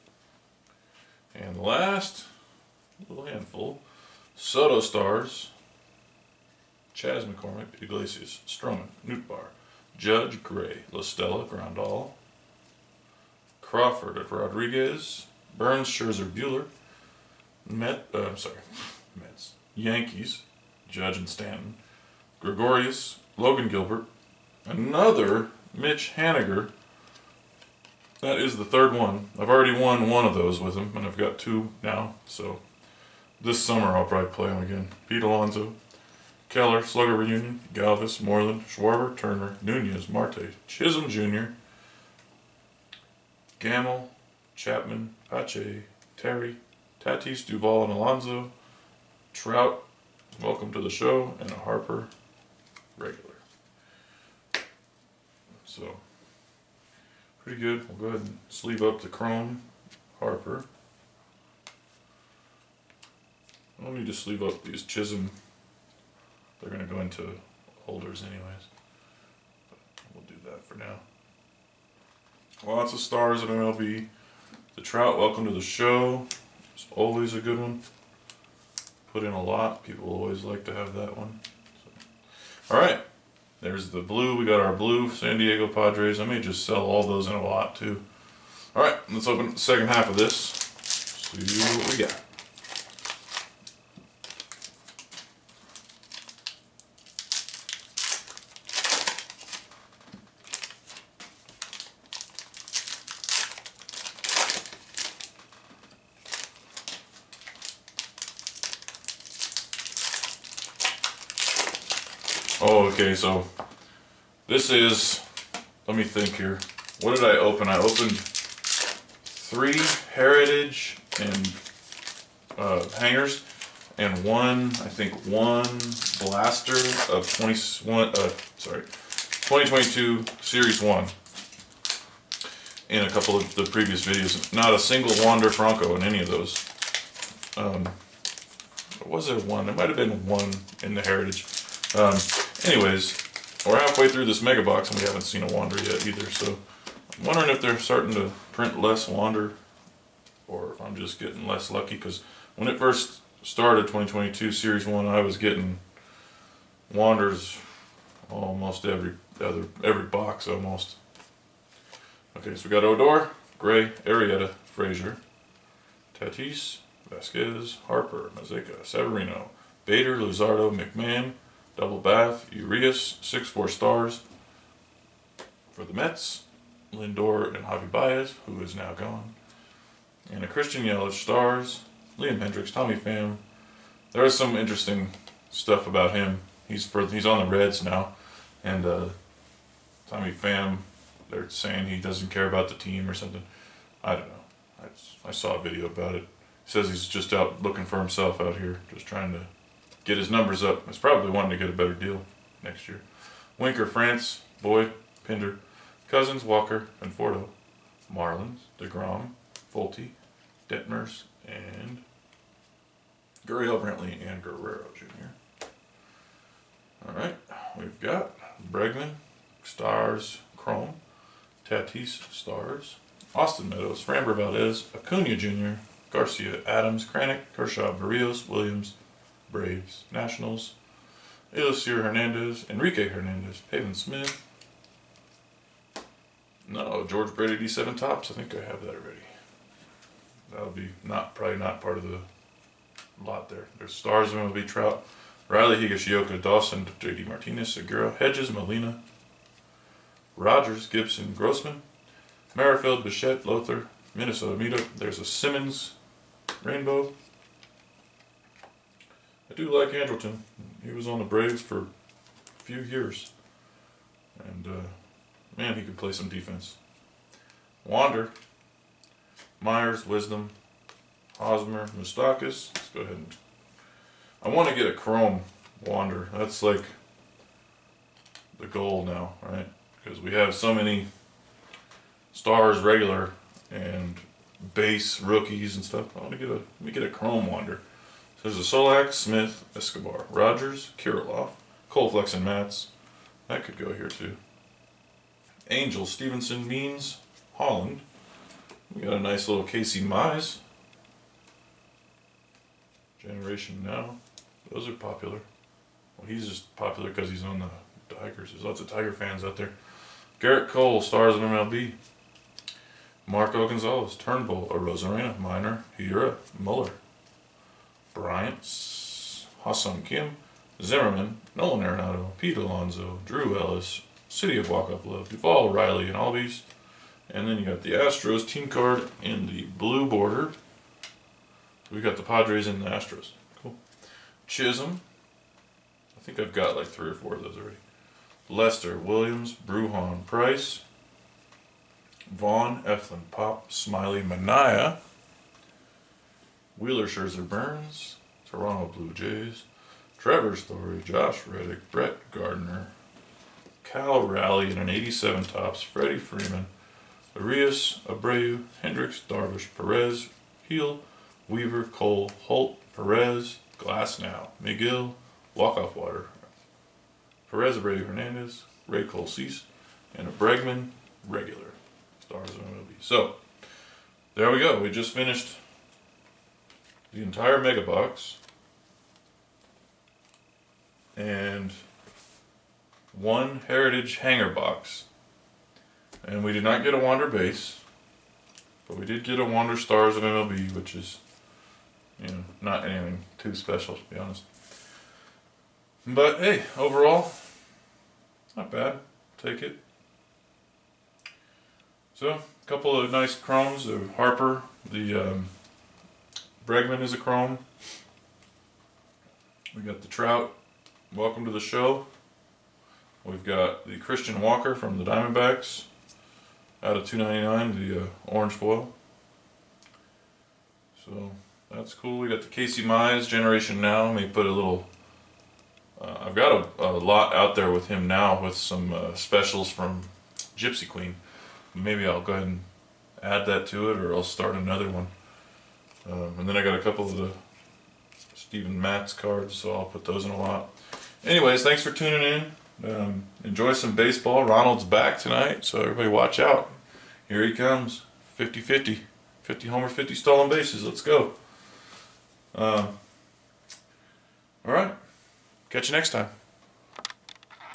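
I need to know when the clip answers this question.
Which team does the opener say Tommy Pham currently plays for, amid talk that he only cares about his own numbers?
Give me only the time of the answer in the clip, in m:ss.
3:07.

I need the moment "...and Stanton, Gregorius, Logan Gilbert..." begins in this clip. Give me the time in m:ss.
0:21.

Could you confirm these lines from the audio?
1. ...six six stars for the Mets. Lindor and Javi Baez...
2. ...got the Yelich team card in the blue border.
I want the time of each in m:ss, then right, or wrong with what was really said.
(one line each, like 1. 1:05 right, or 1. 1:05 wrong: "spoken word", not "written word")
1. 2:53 wrong: "four", not "six"
2. 5:27 wrong: "Astros", not "Yelich".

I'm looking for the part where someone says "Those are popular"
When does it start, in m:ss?
5:04.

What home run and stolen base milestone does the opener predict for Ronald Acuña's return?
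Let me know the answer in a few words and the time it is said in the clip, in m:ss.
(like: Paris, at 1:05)
50-50, at 7:28.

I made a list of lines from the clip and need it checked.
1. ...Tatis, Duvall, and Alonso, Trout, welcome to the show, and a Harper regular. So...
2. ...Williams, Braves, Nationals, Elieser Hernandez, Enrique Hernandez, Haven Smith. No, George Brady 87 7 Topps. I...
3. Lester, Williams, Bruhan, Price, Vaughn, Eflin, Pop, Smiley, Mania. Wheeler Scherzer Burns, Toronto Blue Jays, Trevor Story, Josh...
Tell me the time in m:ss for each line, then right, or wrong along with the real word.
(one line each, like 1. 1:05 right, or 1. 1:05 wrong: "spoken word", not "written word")
1. 0:47 right
2. 3:48 right
3. 5:38 right.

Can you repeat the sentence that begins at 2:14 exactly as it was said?
Not a single Wander Franco in any of those.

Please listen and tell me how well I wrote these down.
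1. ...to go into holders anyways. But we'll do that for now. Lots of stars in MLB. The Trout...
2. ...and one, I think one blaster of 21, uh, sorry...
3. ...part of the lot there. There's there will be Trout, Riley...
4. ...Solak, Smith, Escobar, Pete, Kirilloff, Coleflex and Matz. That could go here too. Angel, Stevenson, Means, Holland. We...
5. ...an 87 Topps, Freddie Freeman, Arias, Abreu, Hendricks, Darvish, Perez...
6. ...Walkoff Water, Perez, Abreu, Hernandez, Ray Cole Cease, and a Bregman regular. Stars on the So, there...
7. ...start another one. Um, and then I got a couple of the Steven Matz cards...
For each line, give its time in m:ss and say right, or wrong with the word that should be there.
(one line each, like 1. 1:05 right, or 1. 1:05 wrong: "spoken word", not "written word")
1. 1:06 right
2. 2:03 right
3. 4:01 right
4. 4:48 wrong: "Rogers", not "Pete"
5. 5:54 right
6. 6:05 right
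7. 7:14 right.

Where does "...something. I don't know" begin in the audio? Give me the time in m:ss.
3:13.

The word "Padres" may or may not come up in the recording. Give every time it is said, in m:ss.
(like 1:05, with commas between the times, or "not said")
1:25, 5:32.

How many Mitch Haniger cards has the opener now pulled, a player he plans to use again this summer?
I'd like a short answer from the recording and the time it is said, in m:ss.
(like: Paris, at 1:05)
3, at 0:28.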